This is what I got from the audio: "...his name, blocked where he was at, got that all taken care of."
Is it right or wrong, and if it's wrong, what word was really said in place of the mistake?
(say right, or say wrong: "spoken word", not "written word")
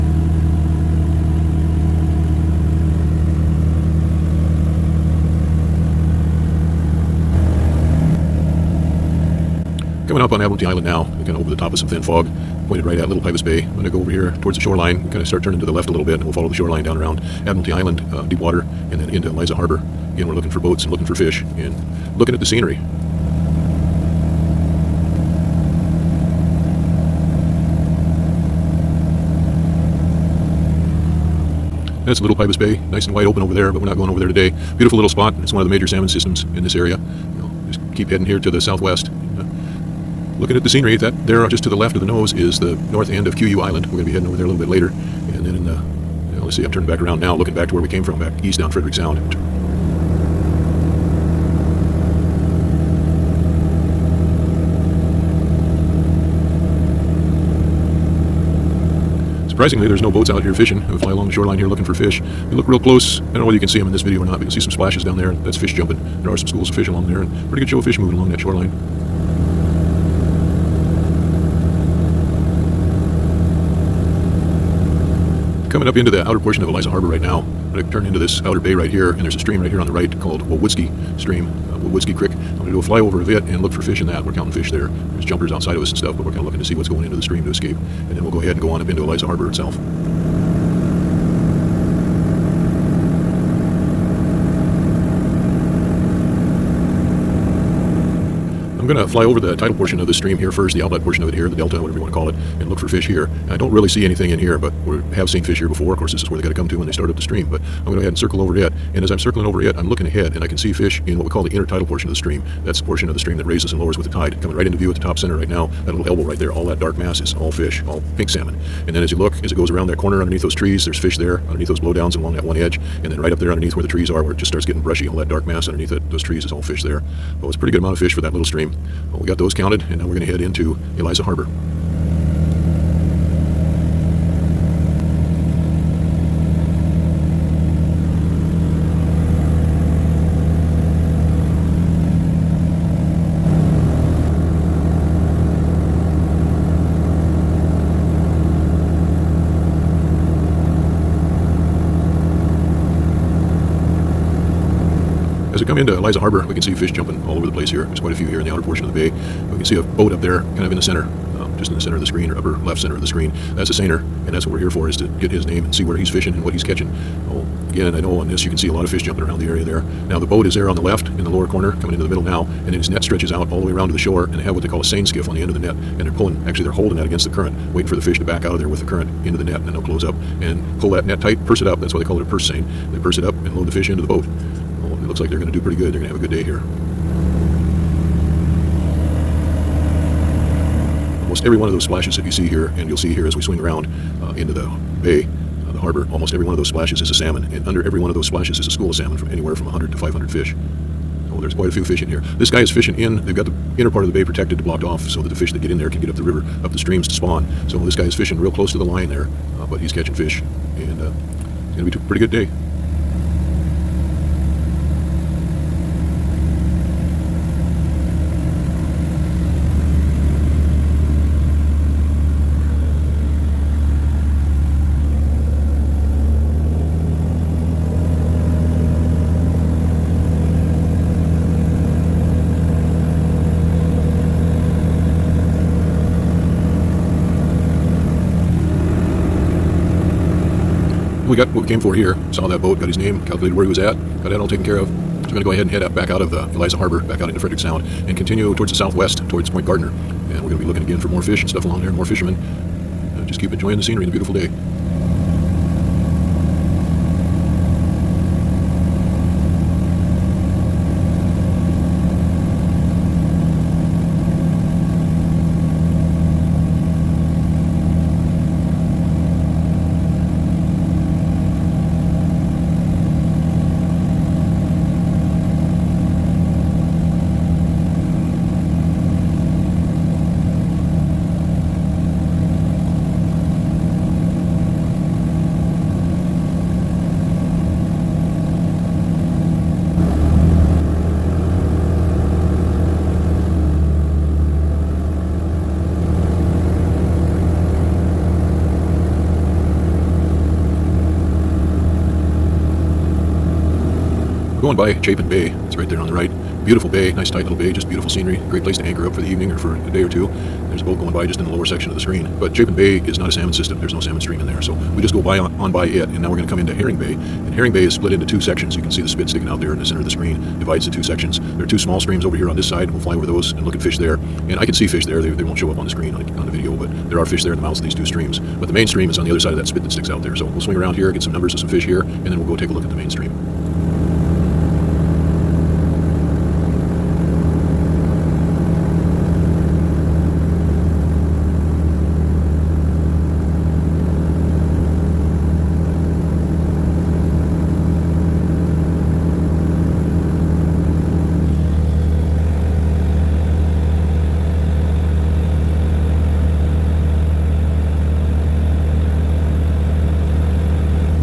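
wrong: "calculated", not "blocked".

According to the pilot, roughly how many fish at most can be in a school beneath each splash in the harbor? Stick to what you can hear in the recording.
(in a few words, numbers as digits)
500.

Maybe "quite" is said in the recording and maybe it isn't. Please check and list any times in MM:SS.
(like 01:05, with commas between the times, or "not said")
02:37, 03:21.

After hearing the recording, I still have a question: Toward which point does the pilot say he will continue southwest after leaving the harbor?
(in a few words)
Point Gardner.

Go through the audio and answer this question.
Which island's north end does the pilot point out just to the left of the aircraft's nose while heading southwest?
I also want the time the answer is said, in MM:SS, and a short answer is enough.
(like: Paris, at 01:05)
Kuiu Island, at 00:43.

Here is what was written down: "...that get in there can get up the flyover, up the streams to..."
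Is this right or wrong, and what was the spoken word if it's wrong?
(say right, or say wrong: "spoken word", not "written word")
wrong: "river", not "flyover".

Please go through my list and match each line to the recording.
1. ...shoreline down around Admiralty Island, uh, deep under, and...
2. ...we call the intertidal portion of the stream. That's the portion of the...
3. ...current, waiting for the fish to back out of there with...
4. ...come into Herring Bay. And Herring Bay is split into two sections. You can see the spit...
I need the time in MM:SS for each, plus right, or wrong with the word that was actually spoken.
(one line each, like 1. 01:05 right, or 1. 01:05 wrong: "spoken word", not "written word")
1. 00:16 wrong: "water", not "under"
2. 01:51 right
3. 02:57 right
4. 05:16 right.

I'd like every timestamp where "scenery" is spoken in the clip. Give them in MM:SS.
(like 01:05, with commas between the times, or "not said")
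00:22, 00:40, 04:13, 05:08.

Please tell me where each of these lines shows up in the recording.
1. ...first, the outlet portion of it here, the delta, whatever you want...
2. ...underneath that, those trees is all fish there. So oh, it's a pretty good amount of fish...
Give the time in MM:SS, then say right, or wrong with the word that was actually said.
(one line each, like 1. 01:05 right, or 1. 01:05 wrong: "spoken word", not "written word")
1. 01:40 right
2. 02:05 right.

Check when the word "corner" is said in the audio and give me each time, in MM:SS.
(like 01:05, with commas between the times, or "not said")
01:59, 02:51.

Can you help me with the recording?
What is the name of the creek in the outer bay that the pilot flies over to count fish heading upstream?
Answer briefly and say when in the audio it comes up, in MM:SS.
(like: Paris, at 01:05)
Wawutski Creek, at 01:21.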